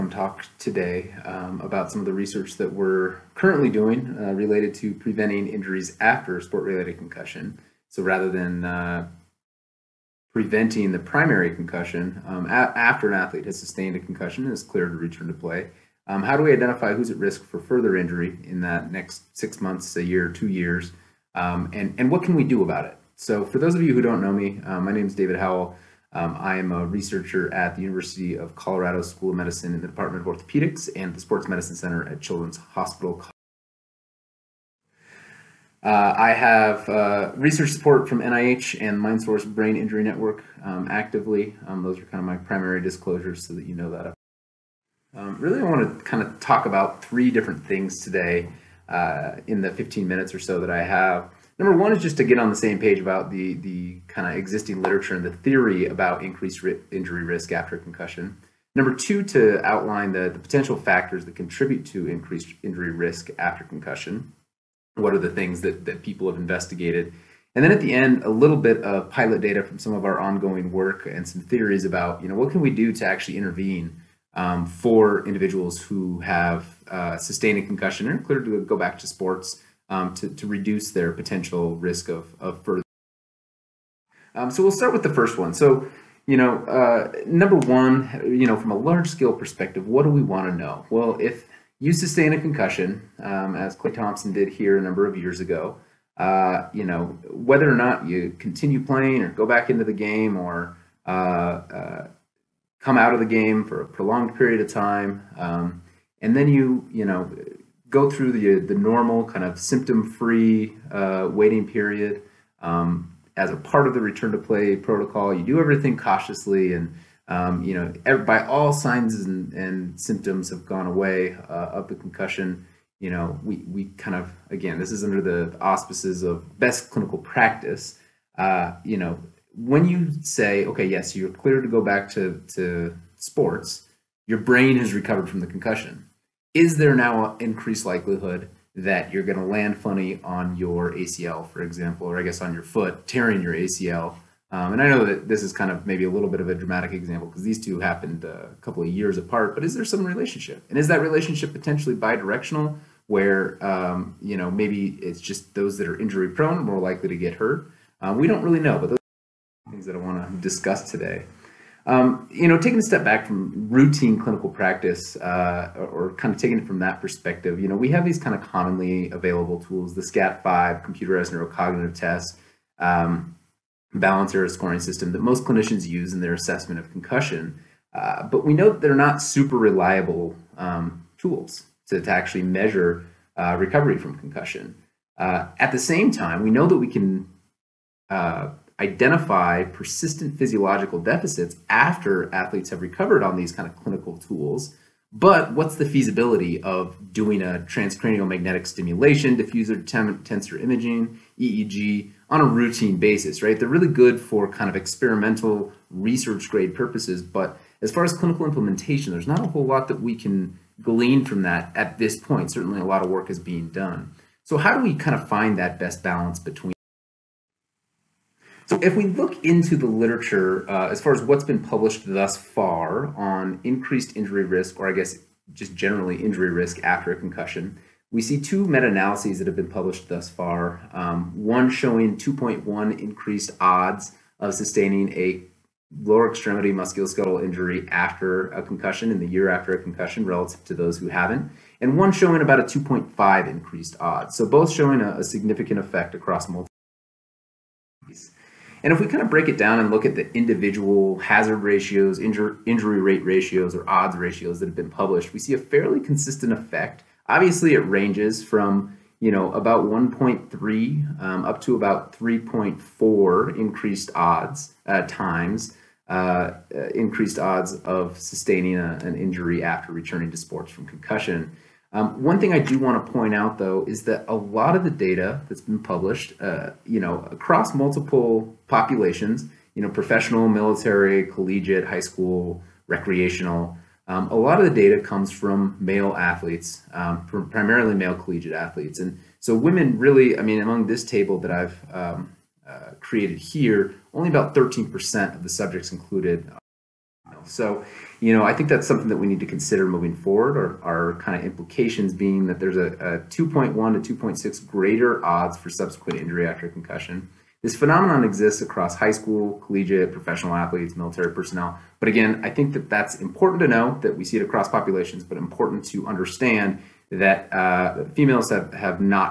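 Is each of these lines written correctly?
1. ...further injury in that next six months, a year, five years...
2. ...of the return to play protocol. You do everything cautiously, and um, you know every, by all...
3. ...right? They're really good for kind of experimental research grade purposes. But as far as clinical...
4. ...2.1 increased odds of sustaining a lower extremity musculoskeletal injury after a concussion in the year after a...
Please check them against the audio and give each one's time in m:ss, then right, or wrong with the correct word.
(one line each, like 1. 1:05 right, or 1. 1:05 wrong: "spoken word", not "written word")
1. 0:17 wrong: "two", not "five"
2. 1:53 right
3. 3:23 right
4. 3:52 right.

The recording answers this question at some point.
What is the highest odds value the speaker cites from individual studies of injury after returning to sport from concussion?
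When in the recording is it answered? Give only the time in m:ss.
4:22.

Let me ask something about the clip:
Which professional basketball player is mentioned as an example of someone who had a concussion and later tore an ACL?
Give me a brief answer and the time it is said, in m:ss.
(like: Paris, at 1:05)
Klay Thompson, at 1:33.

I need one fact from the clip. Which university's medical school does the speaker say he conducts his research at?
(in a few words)
University of Colorado.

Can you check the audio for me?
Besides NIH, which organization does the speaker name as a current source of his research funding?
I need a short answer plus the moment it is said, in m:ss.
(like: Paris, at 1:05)
MindSource Brain Injury Network, at 0:38.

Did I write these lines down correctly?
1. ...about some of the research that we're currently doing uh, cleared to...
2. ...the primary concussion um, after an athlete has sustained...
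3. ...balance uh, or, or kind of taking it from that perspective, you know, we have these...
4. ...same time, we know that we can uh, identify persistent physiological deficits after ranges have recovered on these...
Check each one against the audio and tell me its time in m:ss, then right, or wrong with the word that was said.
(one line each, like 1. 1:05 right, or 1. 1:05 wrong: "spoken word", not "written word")
1. 0:01 wrong: "related", not "cleared"
2. 0:10 right
3. 2:44 wrong: "practice", not "balance"
4. 3:05 wrong: "athletes", not "ranges".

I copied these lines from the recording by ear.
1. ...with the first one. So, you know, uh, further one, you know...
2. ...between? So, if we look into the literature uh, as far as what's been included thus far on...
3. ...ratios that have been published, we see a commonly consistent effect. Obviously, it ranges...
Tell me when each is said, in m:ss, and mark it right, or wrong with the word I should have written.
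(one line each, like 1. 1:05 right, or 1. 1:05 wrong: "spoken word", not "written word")
1. 1:24 wrong: "number", not "further"
2. 3:36 wrong: "published", not "included"
3. 4:14 wrong: "fairly", not "commonly".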